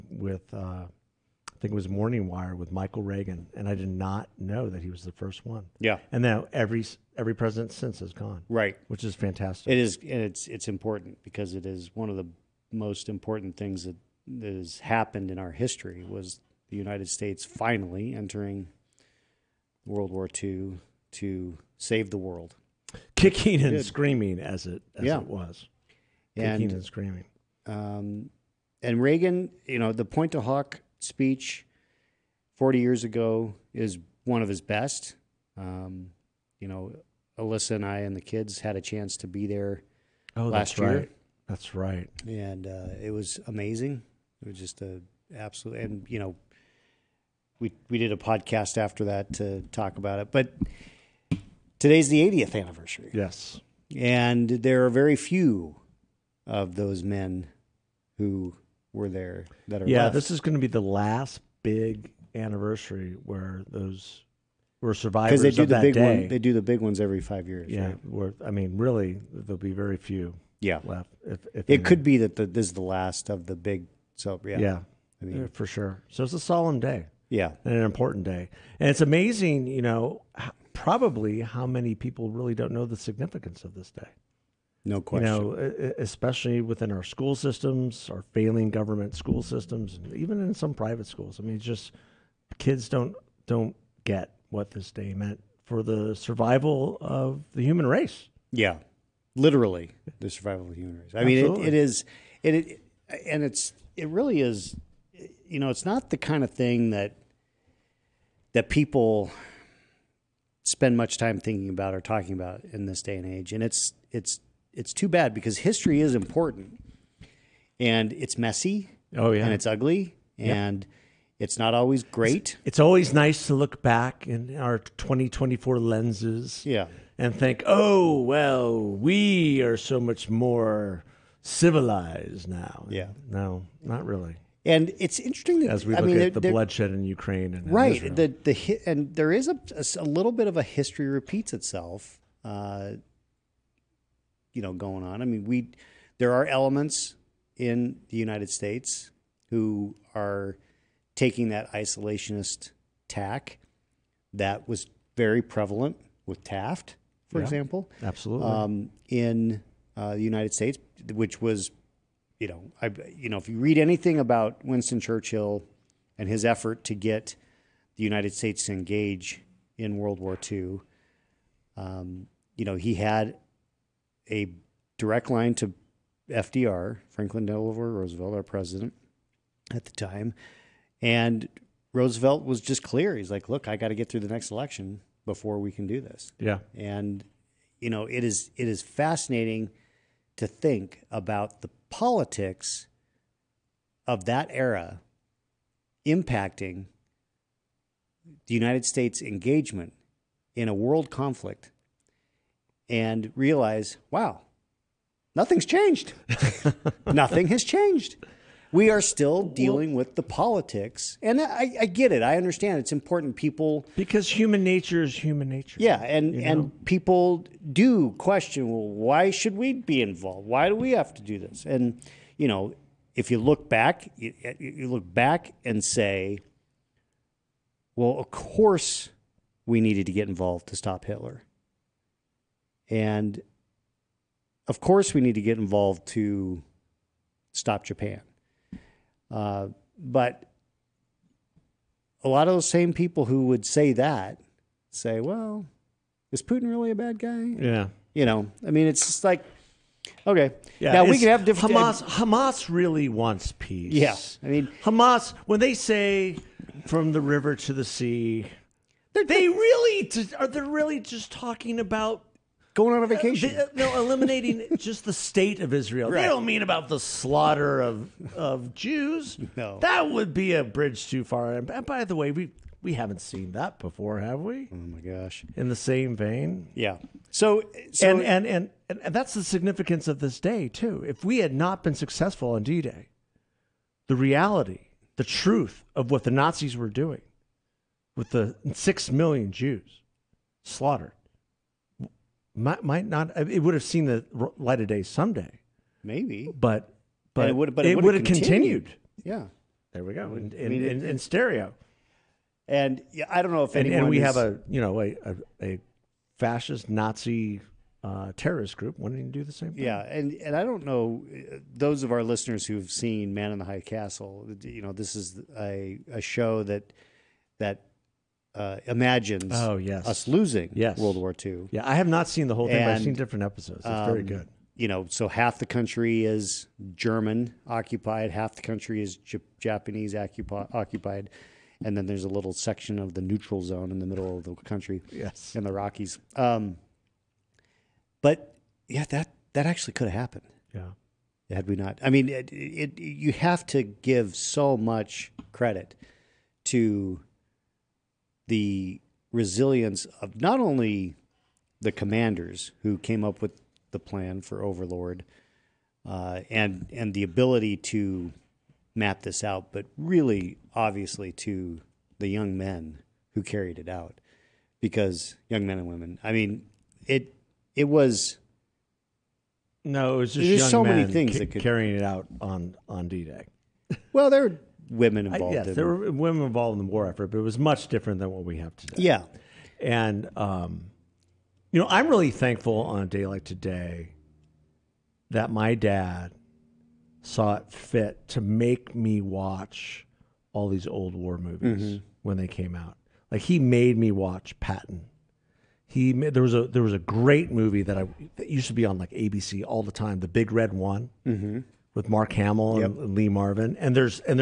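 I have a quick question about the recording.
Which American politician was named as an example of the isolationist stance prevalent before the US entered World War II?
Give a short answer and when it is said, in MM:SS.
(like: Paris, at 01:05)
Taft, at 02:36.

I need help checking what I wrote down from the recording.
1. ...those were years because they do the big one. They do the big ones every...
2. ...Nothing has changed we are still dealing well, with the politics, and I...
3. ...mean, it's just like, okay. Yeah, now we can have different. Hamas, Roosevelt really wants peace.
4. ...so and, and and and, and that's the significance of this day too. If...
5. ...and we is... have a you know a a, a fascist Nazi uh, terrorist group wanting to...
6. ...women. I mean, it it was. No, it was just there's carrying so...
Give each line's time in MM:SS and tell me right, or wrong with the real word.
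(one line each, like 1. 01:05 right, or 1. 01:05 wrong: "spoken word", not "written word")
1. 01:03 wrong: "survivors", not "years"
2. 03:27 right
3. 04:08 wrong: "Hamas", not "Roosevelt"
4. 04:37 right
5. 05:04 right
6. 06:05 wrong: "young", not "carrying".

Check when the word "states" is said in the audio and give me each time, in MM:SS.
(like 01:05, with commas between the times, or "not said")
00:17, 02:28, 02:40, 02:48, 03:18, 04:25.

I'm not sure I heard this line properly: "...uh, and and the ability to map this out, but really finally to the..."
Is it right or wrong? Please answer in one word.
wrong.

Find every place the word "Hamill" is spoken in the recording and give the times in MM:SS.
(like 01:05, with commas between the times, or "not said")
06:42.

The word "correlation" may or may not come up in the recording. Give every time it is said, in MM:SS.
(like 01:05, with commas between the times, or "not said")
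not said.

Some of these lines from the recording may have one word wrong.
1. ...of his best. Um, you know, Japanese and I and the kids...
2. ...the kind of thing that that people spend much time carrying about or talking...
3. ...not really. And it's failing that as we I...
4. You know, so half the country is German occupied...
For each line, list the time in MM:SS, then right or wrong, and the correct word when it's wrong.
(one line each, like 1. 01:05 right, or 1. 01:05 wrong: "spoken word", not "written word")
1. 00:34 wrong: "Alyssa", not "Japanese"
2. 01:46 wrong: "thinking", not "carrying"
3. 02:13 wrong: "interesting", not "failing"
4. 05:24 right.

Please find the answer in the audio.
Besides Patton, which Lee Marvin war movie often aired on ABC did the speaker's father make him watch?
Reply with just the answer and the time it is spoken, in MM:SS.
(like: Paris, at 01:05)
The Big Red One, at 06:40.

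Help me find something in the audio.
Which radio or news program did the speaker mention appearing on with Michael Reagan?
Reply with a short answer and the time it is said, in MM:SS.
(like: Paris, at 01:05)
Morning Wire, at 00:01.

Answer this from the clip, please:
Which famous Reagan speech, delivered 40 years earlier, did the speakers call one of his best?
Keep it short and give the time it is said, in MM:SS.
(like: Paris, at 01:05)
Pointe du Hoc speech, at 00:30.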